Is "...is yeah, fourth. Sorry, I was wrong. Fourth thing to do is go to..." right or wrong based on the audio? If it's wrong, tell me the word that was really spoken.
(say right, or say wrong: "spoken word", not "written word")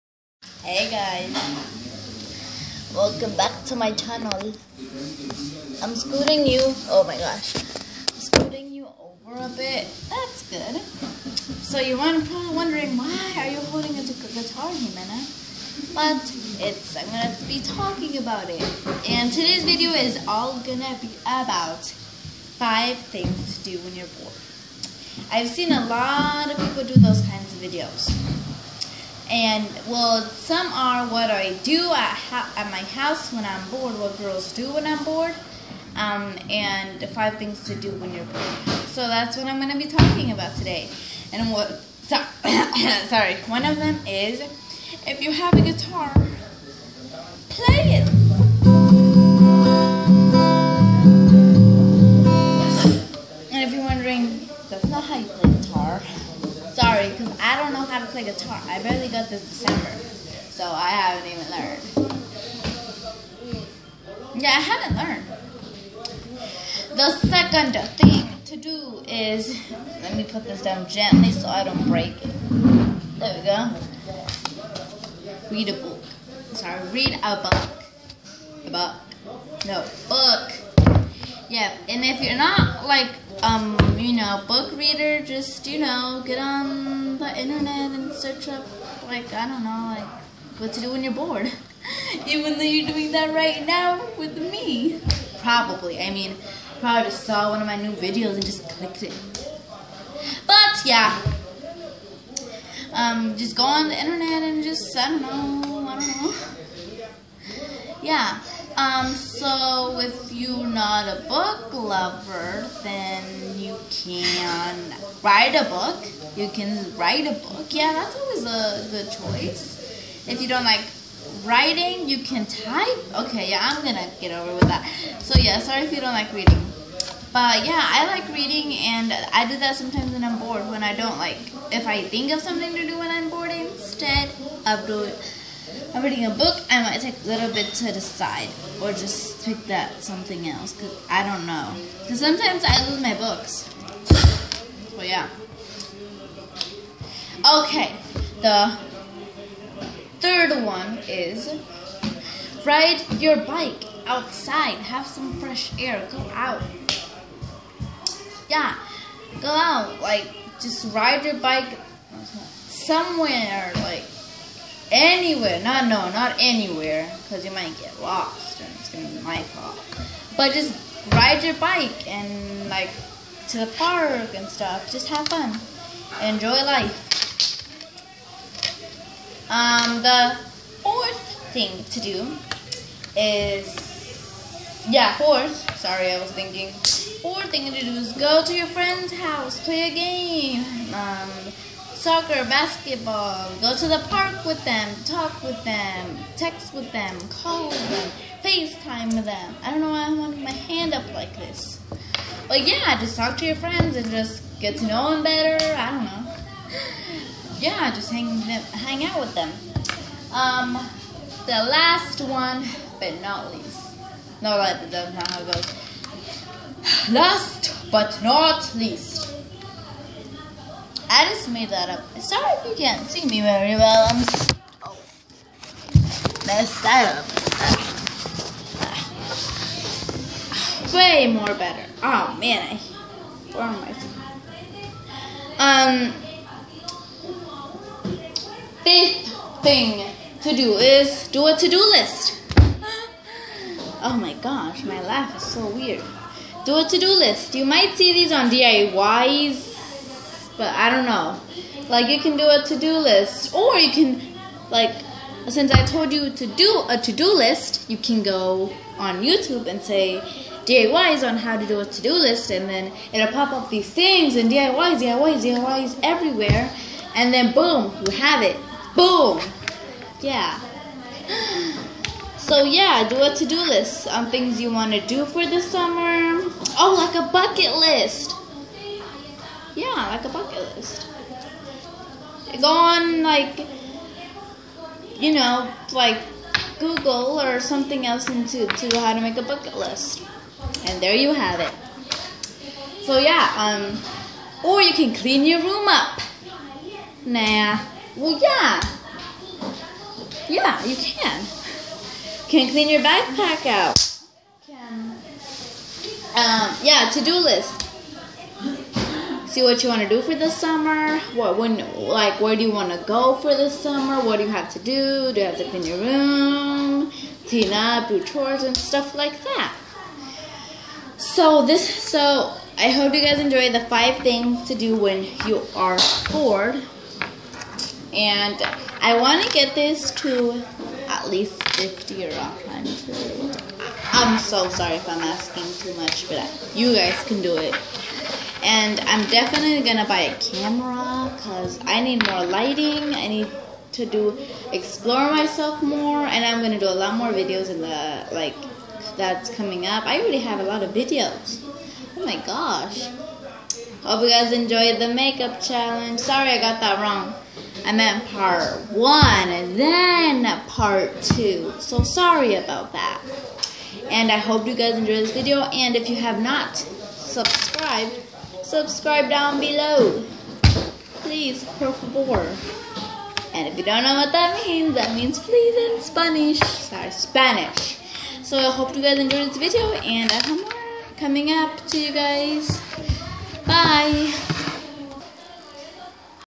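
wrong: "thinking", not "wrong".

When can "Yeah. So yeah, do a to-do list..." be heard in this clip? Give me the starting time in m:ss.
4:30.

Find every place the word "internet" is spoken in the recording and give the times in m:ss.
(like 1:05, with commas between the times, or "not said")
1:27, 1:43.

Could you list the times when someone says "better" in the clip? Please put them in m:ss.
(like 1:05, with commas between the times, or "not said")
3:25, 3:51.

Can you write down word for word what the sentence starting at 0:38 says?
So that's what I'm going to be talking about today.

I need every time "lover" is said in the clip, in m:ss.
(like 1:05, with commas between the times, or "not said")
1:51.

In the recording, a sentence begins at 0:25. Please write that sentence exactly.
I've seen a lot of people do those kinds of videos.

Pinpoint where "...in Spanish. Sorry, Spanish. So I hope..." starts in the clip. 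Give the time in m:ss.
6:15.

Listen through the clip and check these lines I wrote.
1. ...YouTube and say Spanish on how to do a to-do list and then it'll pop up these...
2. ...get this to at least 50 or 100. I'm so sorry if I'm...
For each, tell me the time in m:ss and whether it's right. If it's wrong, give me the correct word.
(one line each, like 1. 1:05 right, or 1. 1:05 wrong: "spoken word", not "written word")
1. 4:19 wrong: "DIYs", not "Spanish"
2. 5:29 right.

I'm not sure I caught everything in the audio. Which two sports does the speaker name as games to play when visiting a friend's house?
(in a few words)
Soccer, basketball.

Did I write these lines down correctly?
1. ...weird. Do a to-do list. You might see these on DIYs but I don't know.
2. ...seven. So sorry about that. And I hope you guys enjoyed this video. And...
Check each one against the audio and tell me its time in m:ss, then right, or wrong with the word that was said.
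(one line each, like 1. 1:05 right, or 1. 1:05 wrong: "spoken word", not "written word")
1. 4:05 right
2. 6:01 wrong: "two", not "seven".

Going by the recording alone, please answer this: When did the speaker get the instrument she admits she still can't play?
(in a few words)
December.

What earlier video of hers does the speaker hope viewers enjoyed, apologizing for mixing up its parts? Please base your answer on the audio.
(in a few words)
Makeup challenge.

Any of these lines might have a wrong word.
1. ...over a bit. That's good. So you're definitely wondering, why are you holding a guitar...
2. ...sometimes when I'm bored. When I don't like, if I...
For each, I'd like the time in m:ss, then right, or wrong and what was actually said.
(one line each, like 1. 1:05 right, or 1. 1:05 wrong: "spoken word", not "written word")
1. 0:08 wrong: "probably", not "definitely"
2. 2:09 right.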